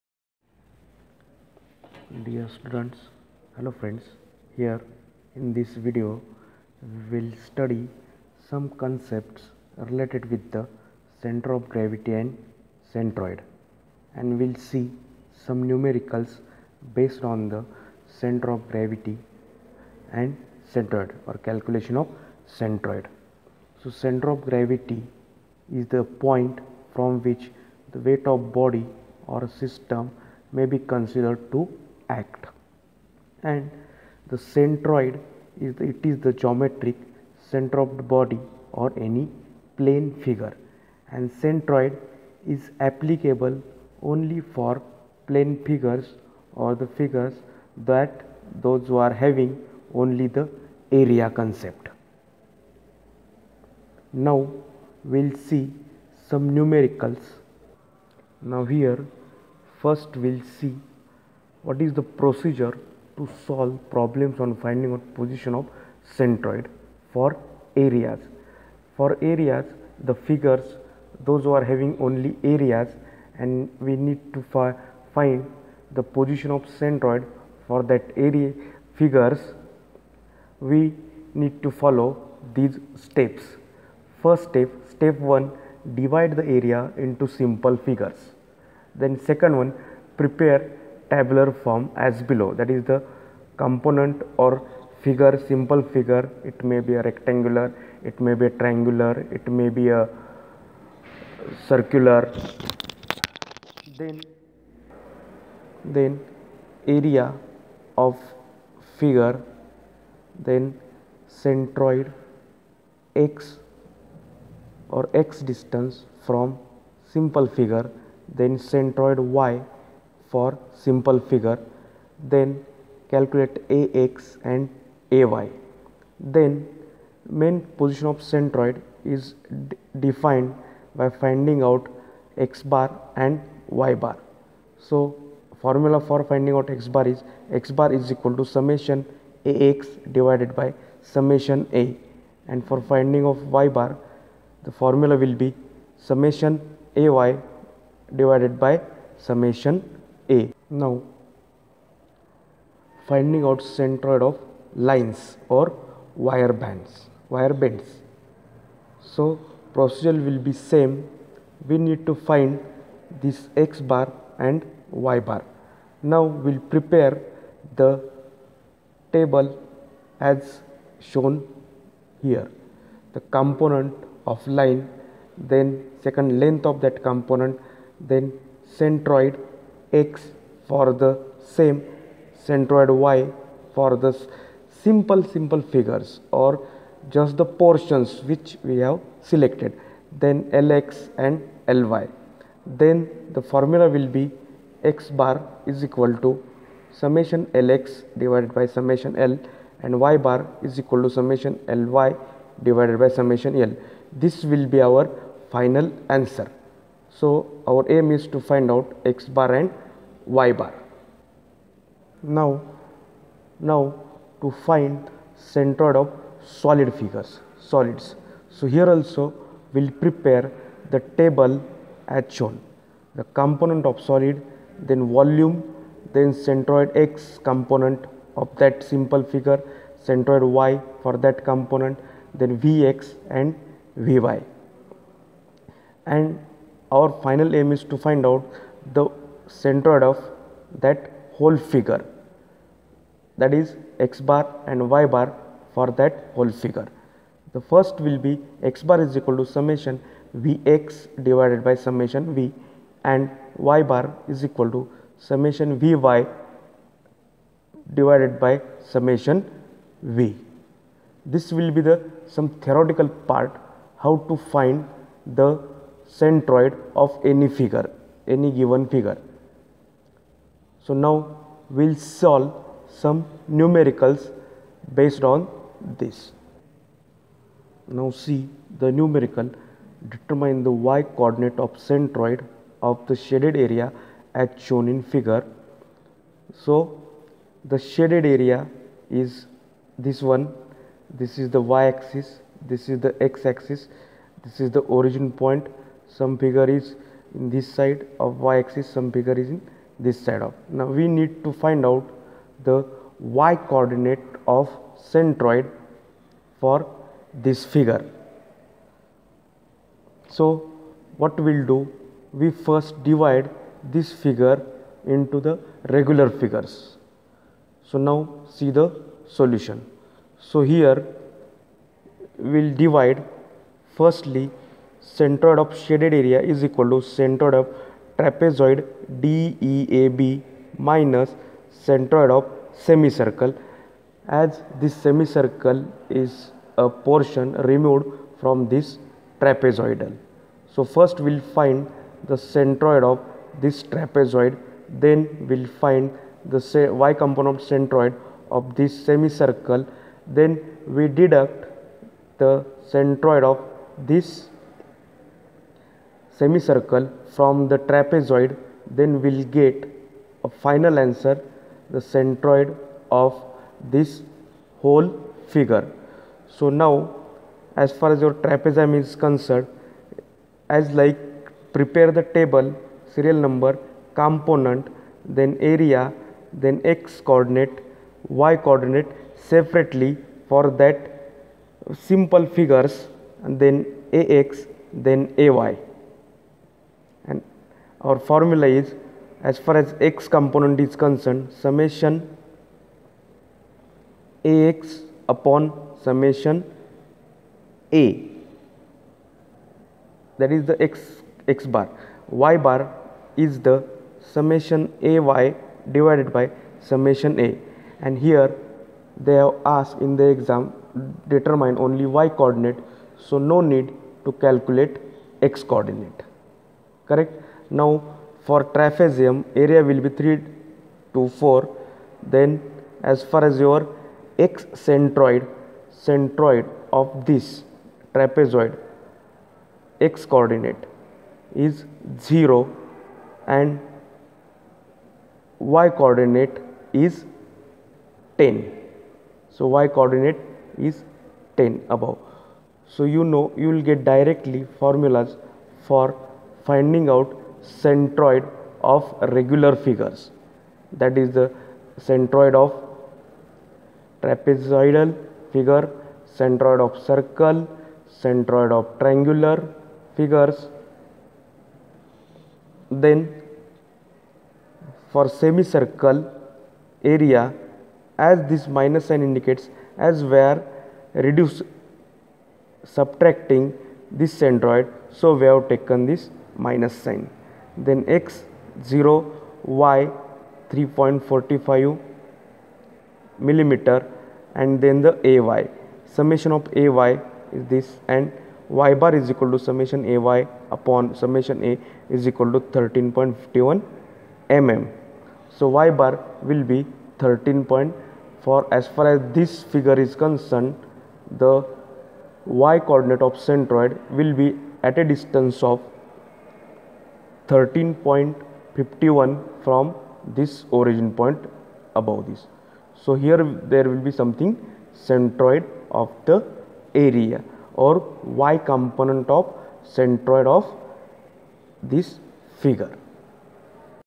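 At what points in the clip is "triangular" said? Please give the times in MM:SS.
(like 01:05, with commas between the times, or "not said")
01:38, 07:38.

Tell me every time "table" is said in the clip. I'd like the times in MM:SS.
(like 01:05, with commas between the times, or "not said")
02:49, 03:40, 06:12.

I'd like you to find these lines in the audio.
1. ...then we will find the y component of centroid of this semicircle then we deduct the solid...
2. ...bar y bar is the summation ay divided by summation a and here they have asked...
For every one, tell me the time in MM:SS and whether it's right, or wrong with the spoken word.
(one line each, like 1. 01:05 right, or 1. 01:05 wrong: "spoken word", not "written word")
1. 05:44 wrong: "centroid", not "solid"
2. 06:41 right.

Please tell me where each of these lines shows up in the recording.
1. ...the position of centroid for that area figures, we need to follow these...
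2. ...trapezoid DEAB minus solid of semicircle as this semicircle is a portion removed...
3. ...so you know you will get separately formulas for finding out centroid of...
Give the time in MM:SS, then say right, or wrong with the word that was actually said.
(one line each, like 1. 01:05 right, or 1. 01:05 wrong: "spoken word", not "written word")
1. 01:15 right
2. 05:28 wrong: "centroid", not "solid"
3. 07:22 wrong: "directly", not "separately".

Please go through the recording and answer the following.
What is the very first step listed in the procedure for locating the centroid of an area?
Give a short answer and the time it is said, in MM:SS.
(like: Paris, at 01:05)
Divide the area into simple figures, at 01:25.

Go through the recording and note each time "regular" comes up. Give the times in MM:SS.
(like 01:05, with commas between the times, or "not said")
05:15, 07:29.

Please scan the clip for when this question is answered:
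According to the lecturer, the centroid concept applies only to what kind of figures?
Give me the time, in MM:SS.
00:45.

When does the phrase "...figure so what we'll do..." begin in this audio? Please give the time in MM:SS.
05:07.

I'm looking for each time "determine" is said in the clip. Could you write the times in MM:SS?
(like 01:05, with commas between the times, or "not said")
04:40, 06:51.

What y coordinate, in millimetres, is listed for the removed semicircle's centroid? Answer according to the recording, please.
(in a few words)
3.45 mm.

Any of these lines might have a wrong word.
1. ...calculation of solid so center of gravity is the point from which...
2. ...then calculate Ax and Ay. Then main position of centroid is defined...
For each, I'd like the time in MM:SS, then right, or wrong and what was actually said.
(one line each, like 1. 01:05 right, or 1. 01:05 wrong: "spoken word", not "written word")
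1. 00:21 wrong: "centroid", not "solid"
2. 02:02 right.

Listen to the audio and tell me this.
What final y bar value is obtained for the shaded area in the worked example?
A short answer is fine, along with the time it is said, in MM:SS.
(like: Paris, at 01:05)
13.51 mm, at 08:12.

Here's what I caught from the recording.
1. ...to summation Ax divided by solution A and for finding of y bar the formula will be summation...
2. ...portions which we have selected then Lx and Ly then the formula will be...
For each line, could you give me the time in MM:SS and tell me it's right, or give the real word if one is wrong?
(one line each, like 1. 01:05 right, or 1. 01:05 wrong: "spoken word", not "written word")
1. 02:18 wrong: "summation", not "solution"
2. 03:07 right.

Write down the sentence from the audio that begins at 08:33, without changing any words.
So, here there will be something centroid of the area or y component of centroid of this figure.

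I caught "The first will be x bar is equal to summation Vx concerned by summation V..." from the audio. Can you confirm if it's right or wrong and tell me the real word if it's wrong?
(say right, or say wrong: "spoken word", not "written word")
wrong: "divided", not "concerned".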